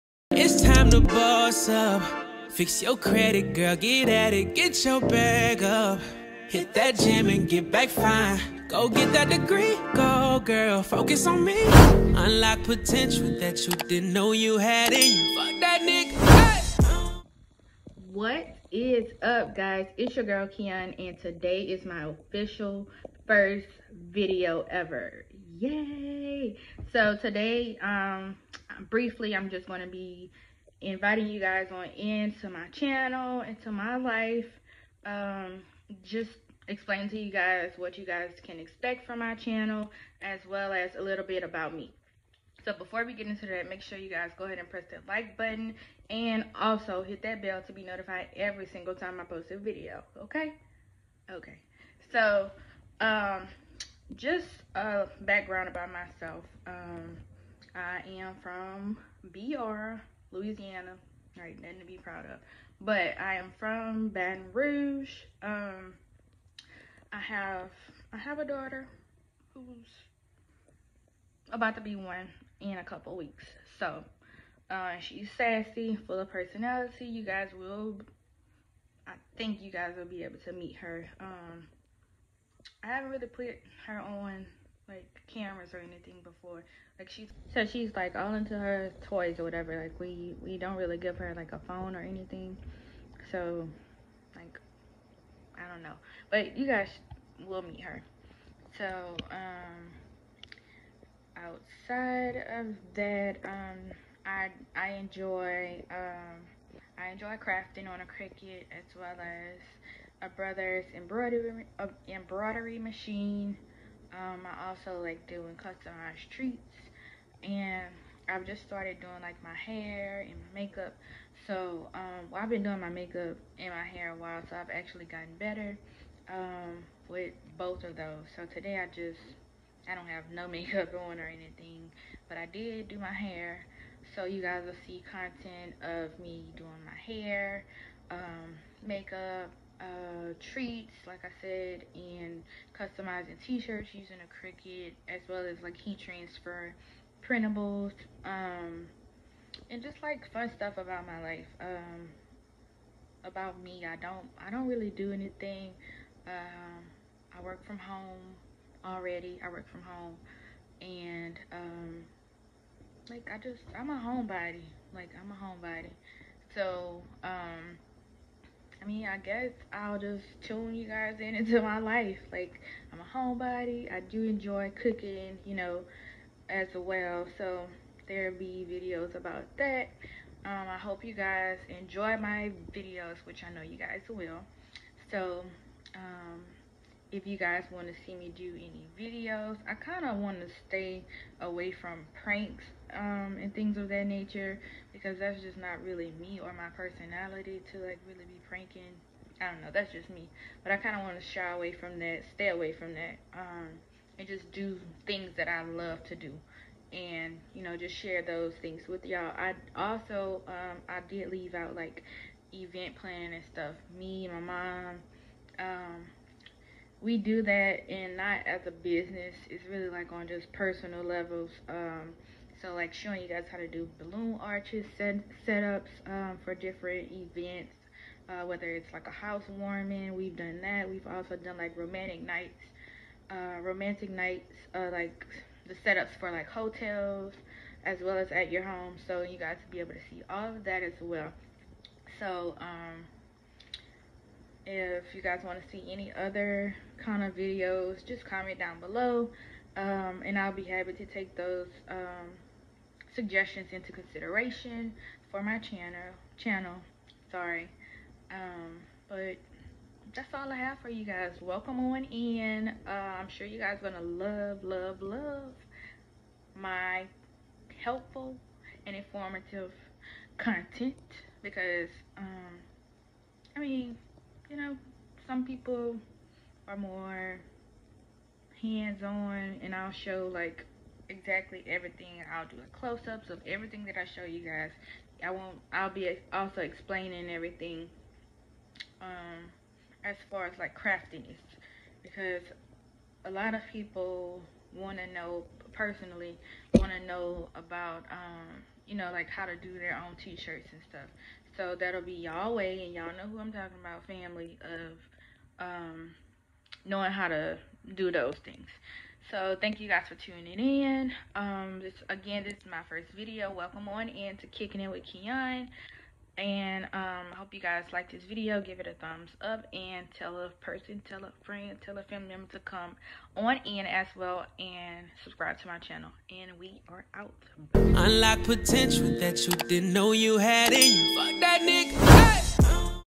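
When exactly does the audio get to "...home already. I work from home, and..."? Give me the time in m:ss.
2:37.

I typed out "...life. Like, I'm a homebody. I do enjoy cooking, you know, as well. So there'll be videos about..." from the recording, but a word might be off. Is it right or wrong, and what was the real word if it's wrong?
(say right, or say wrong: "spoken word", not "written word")
right.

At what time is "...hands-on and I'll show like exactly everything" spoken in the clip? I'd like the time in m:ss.
4:38.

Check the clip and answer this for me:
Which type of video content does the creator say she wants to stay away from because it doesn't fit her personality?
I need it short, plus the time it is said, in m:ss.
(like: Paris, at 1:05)
Pranks, at 3:12.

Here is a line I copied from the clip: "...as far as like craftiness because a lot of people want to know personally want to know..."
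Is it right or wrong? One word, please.
right.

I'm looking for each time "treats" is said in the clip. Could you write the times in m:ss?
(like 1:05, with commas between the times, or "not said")
1:56, 2:20.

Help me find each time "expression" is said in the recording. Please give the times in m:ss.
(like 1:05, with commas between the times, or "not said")
not said.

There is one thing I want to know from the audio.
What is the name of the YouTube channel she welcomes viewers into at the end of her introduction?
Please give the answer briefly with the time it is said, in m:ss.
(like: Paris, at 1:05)
Kicking It with Keon, at 5:14.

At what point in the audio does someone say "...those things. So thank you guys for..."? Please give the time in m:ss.
5:08.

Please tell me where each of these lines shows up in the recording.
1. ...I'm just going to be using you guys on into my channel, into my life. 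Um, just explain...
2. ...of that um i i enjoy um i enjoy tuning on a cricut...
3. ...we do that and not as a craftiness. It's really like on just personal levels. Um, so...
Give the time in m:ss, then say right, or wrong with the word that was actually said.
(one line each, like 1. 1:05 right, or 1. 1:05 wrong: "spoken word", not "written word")
1. 0:29 wrong: "inviting", not "using"
2. 1:42 wrong: "crafting", not "tuning"
3. 3:37 wrong: "business", not "craftiness".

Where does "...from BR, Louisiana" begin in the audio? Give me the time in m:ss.
0:58.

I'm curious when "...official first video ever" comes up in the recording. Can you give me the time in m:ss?
0:22.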